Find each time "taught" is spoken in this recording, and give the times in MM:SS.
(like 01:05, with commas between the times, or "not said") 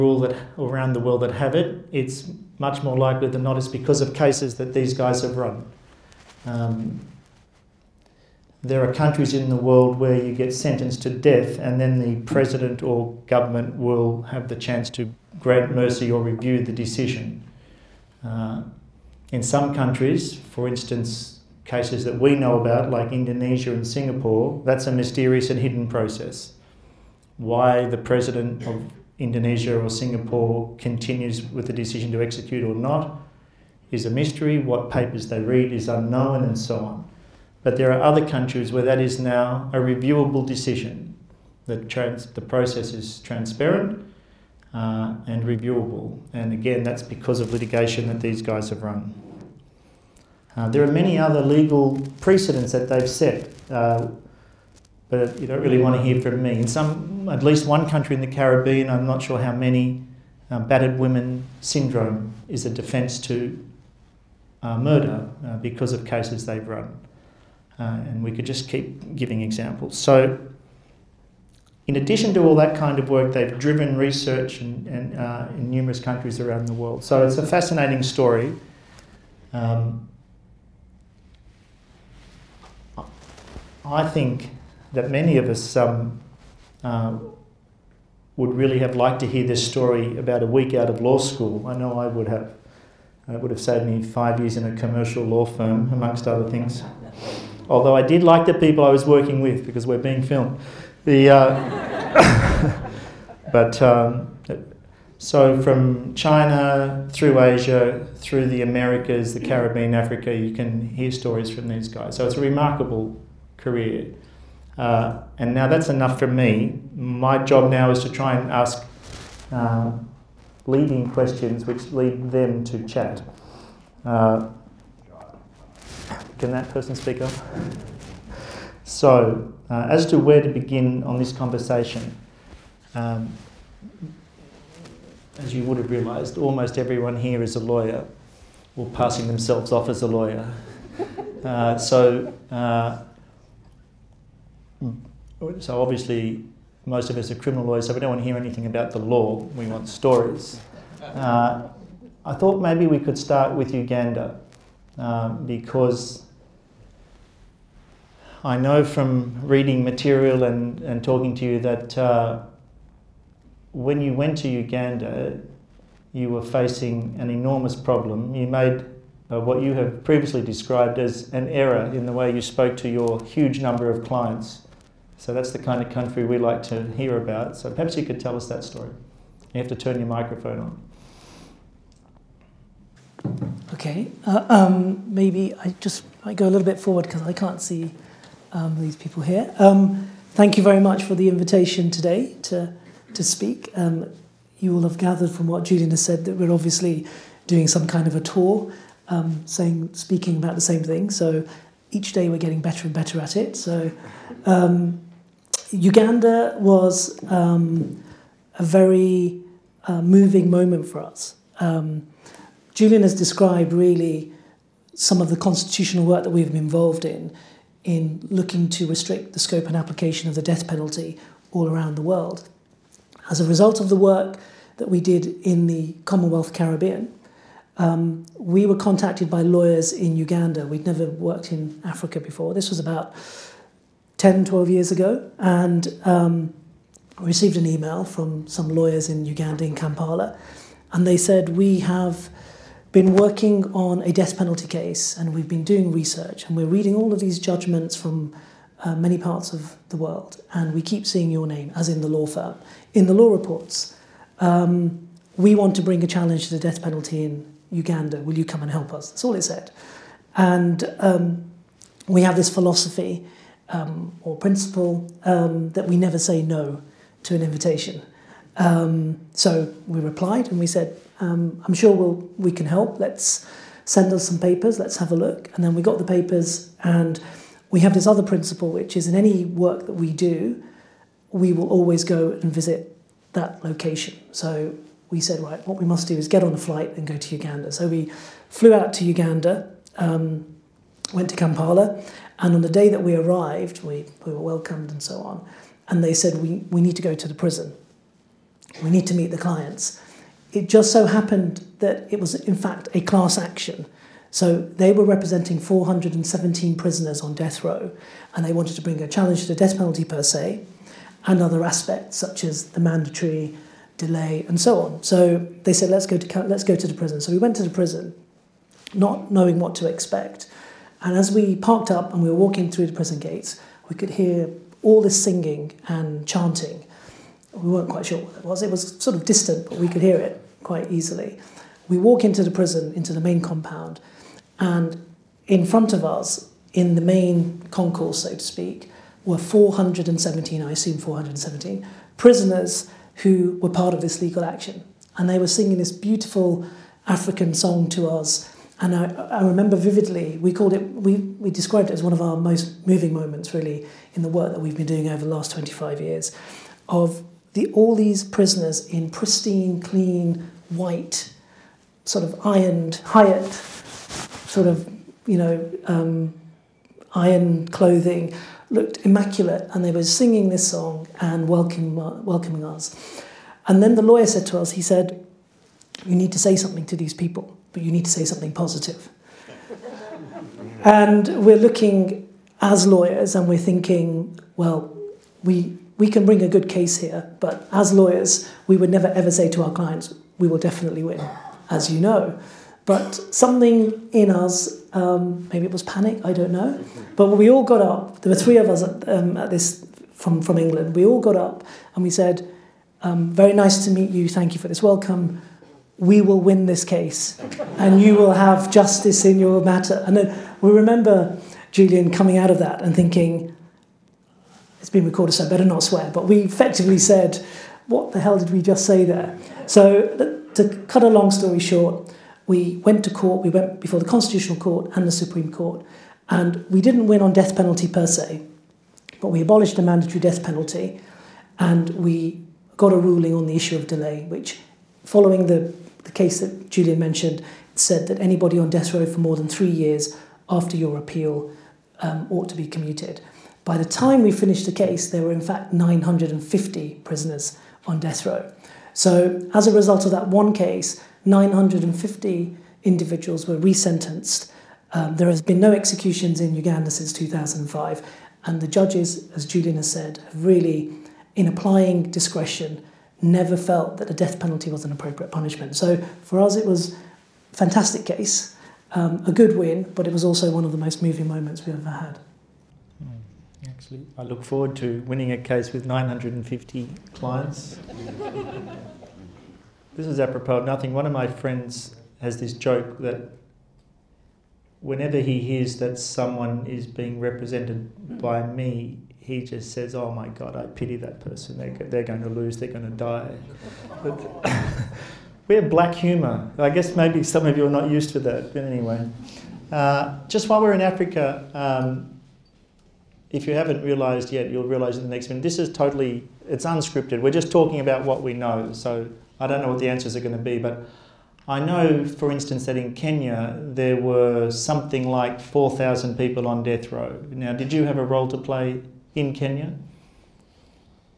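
not said.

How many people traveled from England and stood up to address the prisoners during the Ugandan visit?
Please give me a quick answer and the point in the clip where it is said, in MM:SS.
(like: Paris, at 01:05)
3, at 06:38.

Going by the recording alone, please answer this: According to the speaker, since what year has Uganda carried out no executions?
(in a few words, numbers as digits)
2005.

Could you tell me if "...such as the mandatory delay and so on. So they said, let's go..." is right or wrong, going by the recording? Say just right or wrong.
right.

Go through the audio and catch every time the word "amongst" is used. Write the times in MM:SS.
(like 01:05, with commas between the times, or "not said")
01:35.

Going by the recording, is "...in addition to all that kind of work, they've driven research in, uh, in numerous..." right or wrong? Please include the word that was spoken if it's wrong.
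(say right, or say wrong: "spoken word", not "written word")
right.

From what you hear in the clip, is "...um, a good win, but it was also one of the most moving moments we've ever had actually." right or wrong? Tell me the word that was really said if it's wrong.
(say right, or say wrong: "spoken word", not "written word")
right.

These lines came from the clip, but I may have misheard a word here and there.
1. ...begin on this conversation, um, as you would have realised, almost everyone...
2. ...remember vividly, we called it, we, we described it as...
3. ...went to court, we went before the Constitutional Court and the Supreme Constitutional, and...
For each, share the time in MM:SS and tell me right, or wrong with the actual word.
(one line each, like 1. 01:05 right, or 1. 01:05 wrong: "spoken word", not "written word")
1. 02:10 right
2. 05:49 right
3. 07:02 wrong: "Court", not "Constitutional".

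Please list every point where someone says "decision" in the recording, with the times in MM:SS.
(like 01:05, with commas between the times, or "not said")
00:16, 00:31, 00:40.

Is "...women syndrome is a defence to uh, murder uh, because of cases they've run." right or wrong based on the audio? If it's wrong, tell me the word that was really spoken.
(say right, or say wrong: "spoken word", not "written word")
right.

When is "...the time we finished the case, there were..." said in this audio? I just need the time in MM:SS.
07:23.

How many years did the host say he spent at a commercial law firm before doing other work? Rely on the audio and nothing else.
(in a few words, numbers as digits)
5.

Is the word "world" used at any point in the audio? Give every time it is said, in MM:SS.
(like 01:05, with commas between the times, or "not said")
00:00, 00:09, 01:16, 03:42, 04:09.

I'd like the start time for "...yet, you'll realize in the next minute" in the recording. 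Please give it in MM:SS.
08:24.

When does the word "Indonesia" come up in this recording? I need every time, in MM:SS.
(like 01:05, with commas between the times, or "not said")
00:23, 00:29.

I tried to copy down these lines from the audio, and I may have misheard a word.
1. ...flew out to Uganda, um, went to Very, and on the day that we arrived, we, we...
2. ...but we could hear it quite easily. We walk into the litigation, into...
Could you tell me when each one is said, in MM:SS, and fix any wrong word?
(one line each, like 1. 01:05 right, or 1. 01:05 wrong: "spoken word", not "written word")
1. 04:48 wrong: "Kampala", not "Very"
2. 05:29 wrong: "prison", not "litigation".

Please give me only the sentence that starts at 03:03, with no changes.
Okay, uh, um, maybe I just might go a little bit forward because I can't see um, these people here.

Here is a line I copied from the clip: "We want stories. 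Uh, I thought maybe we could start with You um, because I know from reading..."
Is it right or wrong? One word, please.
wrong.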